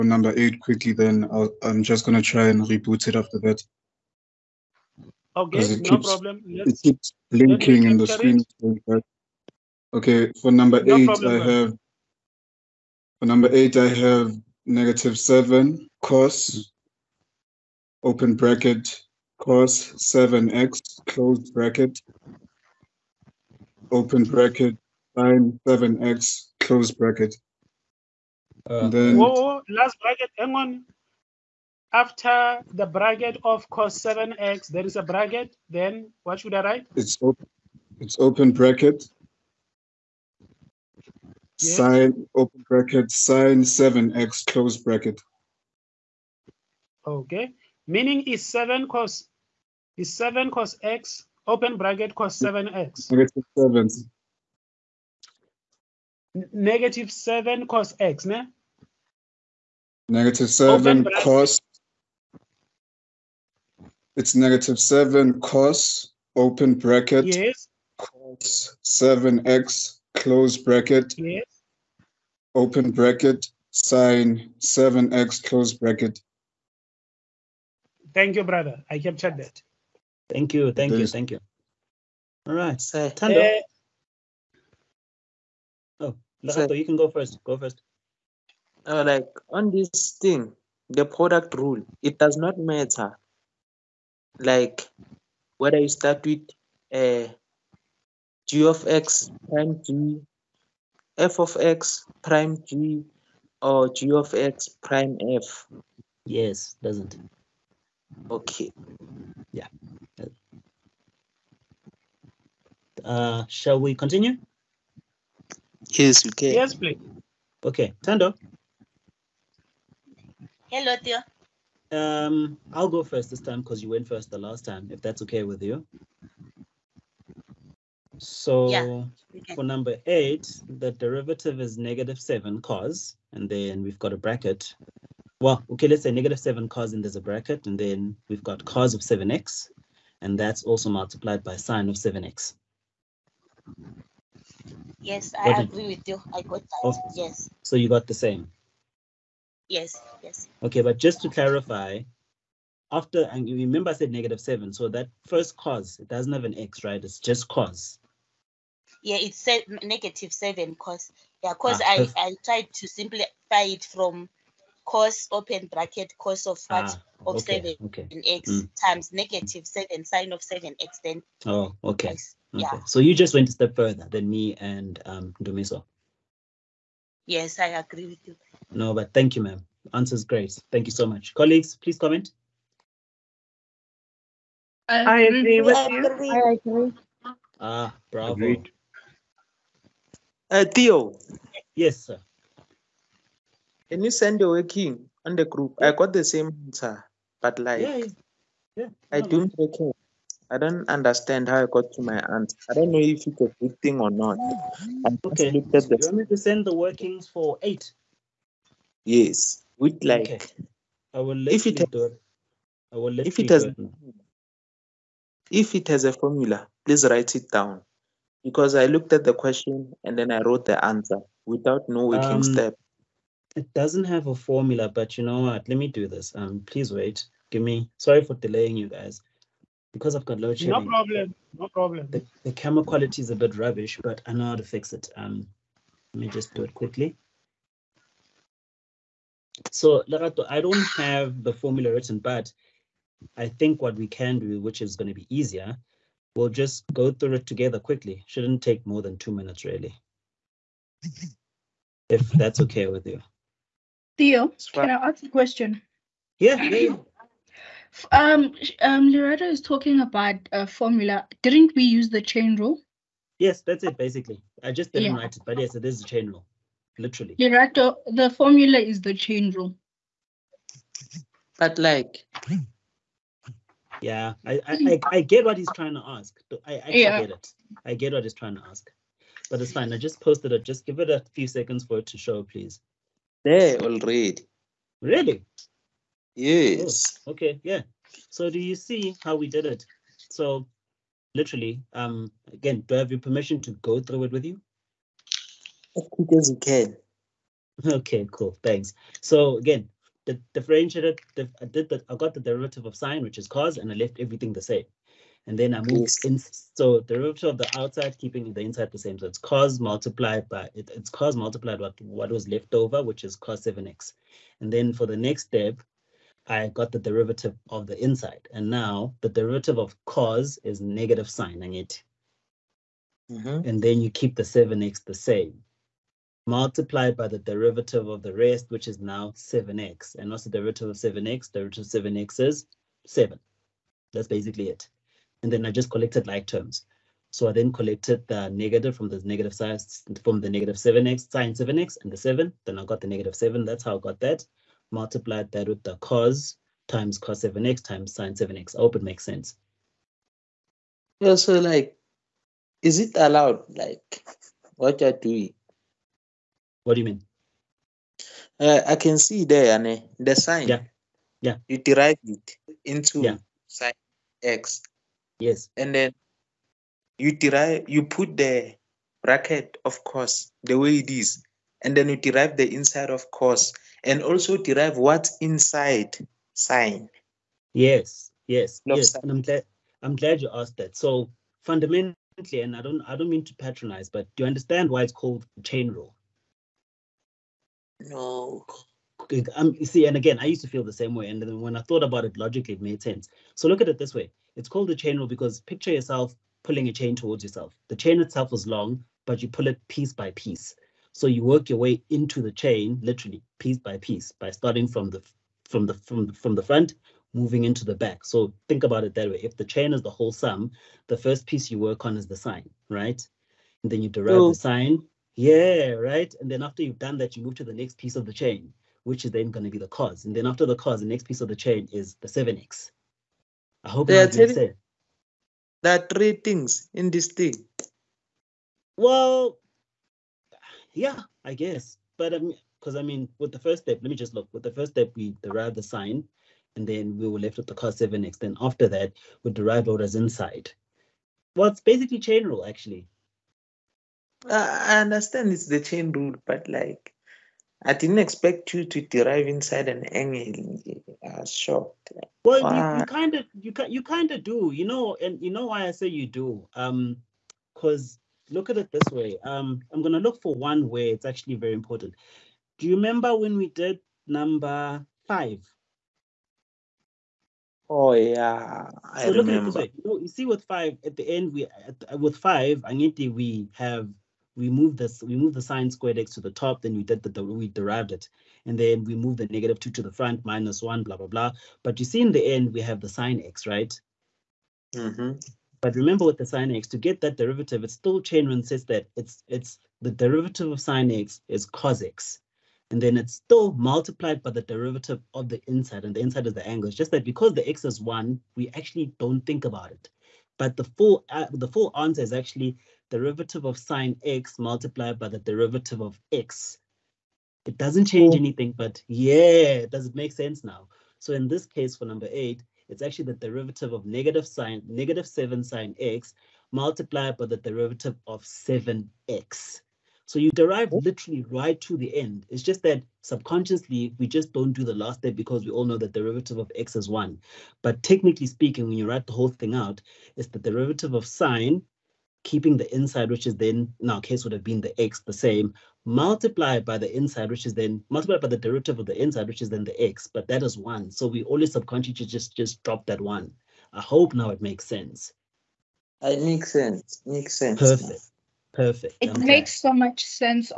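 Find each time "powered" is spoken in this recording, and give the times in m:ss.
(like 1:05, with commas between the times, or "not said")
not said.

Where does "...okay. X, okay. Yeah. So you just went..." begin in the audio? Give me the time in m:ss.
2:51.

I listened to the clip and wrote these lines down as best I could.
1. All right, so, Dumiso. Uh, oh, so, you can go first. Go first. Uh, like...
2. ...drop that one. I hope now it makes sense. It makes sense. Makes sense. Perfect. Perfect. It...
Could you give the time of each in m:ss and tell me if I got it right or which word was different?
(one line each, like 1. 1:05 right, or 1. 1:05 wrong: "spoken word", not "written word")
1. 1:22 wrong: "Tando", not "Dumiso"
2. 9:02 right.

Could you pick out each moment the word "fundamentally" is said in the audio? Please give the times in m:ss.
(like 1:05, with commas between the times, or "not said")
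6:21.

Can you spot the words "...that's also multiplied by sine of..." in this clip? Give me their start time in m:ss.
2:20.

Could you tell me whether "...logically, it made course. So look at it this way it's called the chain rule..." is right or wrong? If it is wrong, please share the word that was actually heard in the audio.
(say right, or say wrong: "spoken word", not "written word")
wrong: "sense", not "course".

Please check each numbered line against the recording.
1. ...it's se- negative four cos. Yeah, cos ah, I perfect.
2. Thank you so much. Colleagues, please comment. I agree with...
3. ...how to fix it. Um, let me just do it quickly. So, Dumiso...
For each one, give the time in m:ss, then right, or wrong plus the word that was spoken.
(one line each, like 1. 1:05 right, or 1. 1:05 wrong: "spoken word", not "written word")
1. 2:39 wrong: "seven", not "four"
2. 3:00 right
3. 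3:54 wrong: "Lerato", not "Dumiso".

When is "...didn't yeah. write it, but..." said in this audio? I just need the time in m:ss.
4:24.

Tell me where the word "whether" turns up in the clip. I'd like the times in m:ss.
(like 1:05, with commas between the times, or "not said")
1:35.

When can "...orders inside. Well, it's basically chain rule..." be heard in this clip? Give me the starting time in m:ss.
7:19.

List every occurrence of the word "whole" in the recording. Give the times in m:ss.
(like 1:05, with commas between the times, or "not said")
6:50, 8:49.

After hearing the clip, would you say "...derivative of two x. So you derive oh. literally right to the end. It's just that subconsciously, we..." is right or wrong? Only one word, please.
wrong.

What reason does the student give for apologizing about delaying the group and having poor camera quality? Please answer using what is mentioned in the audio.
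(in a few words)
load shedding.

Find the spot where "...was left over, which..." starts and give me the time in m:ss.
5:12.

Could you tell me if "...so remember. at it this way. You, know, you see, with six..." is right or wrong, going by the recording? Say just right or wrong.
wrong.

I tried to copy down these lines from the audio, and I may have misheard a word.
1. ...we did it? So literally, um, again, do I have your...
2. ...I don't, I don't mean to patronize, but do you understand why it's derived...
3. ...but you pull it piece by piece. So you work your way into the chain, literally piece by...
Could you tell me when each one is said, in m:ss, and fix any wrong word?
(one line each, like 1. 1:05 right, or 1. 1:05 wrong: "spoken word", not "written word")
1. 4:49 right
2. 6:22 wrong: "called", not "derived"
3. 6:39 right.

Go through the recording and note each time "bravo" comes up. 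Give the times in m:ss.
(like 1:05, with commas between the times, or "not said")
3:08.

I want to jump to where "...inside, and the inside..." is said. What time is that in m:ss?
8:15.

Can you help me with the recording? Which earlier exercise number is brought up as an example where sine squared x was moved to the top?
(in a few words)
5.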